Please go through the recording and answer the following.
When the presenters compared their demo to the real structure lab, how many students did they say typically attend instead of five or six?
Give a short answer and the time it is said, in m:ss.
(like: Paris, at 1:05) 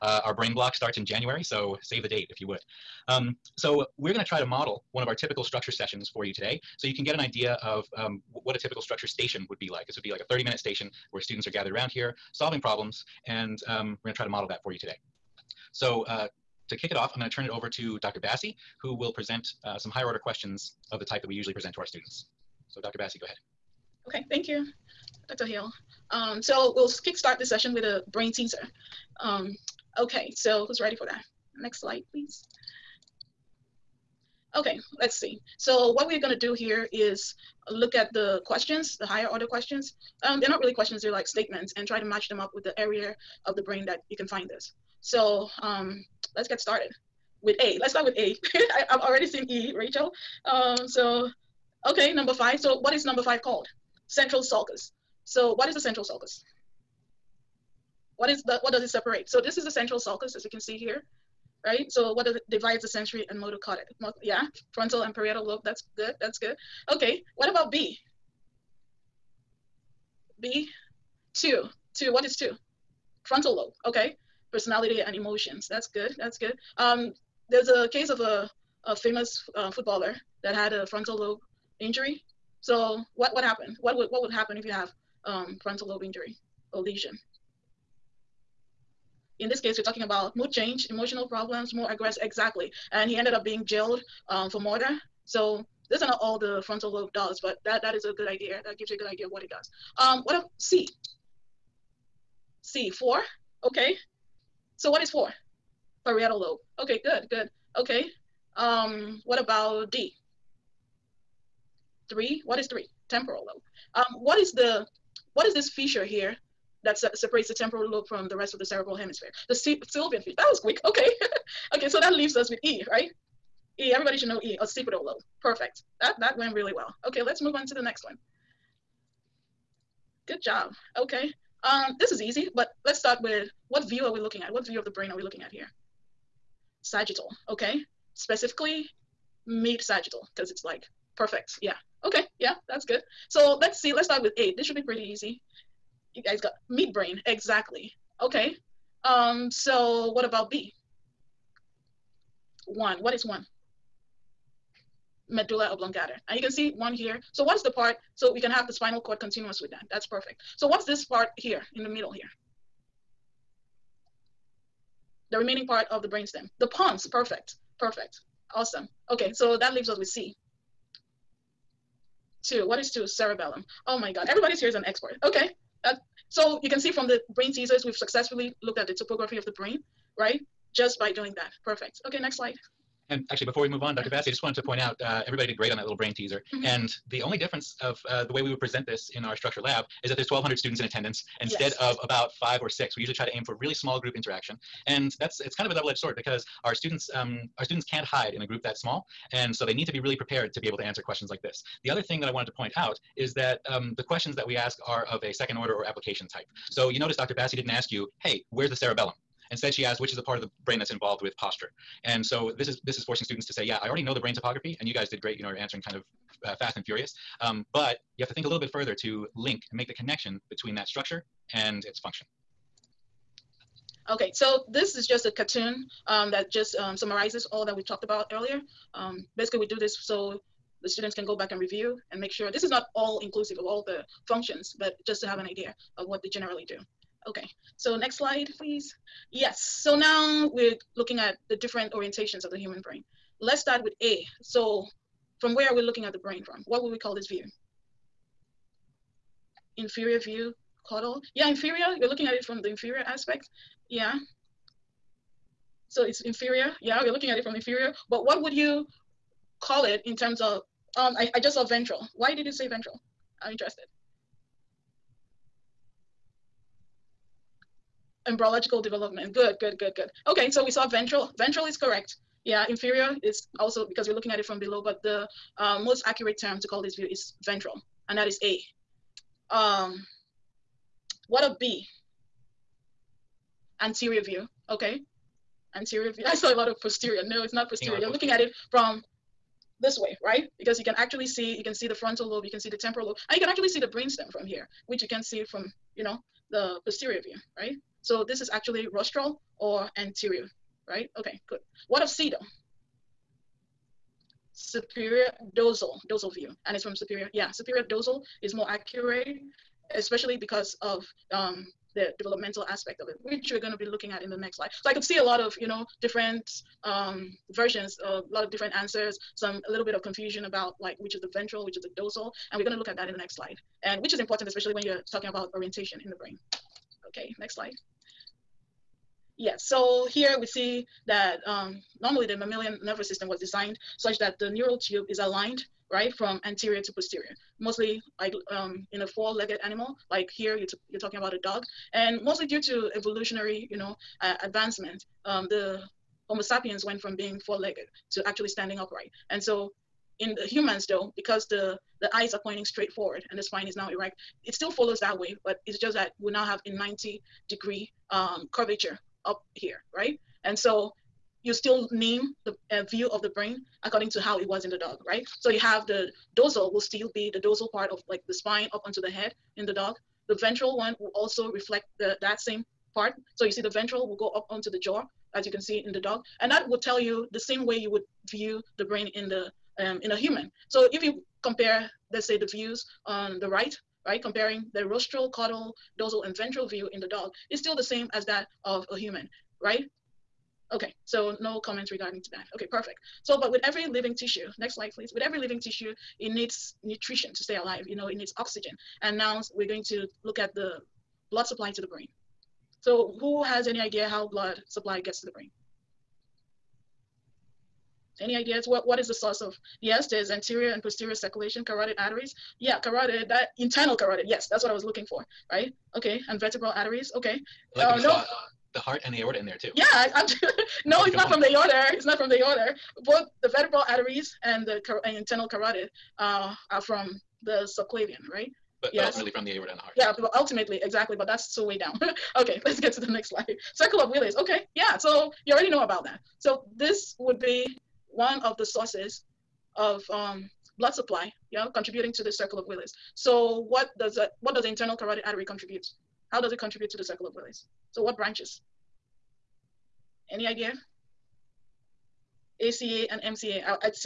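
1,200, at 3:10.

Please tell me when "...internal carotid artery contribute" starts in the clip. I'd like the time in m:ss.
7:24.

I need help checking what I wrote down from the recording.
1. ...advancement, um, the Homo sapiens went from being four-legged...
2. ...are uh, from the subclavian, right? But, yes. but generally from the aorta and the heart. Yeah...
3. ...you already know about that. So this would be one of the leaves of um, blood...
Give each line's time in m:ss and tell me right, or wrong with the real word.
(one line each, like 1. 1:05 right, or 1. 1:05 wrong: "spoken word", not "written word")
1. 5:44 right
2. 7:06 wrong: "ultimately", not "generally"
3. 7:15 wrong: "sources", not "leaves".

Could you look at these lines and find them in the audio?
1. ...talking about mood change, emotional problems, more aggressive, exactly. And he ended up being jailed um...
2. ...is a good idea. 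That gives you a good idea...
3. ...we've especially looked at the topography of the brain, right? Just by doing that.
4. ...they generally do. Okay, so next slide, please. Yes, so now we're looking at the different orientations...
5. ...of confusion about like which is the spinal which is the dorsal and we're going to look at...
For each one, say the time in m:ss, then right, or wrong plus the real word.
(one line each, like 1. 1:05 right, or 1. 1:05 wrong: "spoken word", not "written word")
1. 1:29 right
2. 1:37 right
3. 2:57 wrong: "successfully", not "especially"
4. 3:56 right
5. 5:19 wrong: "ventral", not "spinal".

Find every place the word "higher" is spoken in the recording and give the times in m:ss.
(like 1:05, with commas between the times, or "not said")
0:19, 0:39.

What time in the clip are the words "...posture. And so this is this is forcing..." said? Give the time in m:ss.
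3:31.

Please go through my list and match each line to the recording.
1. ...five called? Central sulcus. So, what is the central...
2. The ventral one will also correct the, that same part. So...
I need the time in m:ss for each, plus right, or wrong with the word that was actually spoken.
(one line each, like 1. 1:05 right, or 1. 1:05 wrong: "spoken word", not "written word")
1. 0:53 right
2. 6:10 wrong: "reflect", not "correct".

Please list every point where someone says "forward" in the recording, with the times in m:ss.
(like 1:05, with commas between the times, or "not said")
5:52.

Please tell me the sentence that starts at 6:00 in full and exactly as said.
And so you still name the uh, view of the brain according to how it was in the dog, right?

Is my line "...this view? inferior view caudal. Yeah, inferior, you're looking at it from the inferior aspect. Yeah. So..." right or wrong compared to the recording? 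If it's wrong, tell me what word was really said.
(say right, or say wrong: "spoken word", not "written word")
right.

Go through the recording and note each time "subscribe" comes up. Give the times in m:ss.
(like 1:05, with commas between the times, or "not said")
not said.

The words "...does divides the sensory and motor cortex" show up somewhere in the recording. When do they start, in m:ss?
1:02.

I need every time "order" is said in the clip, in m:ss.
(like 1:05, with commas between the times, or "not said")
0:20, 0:39, 3:25.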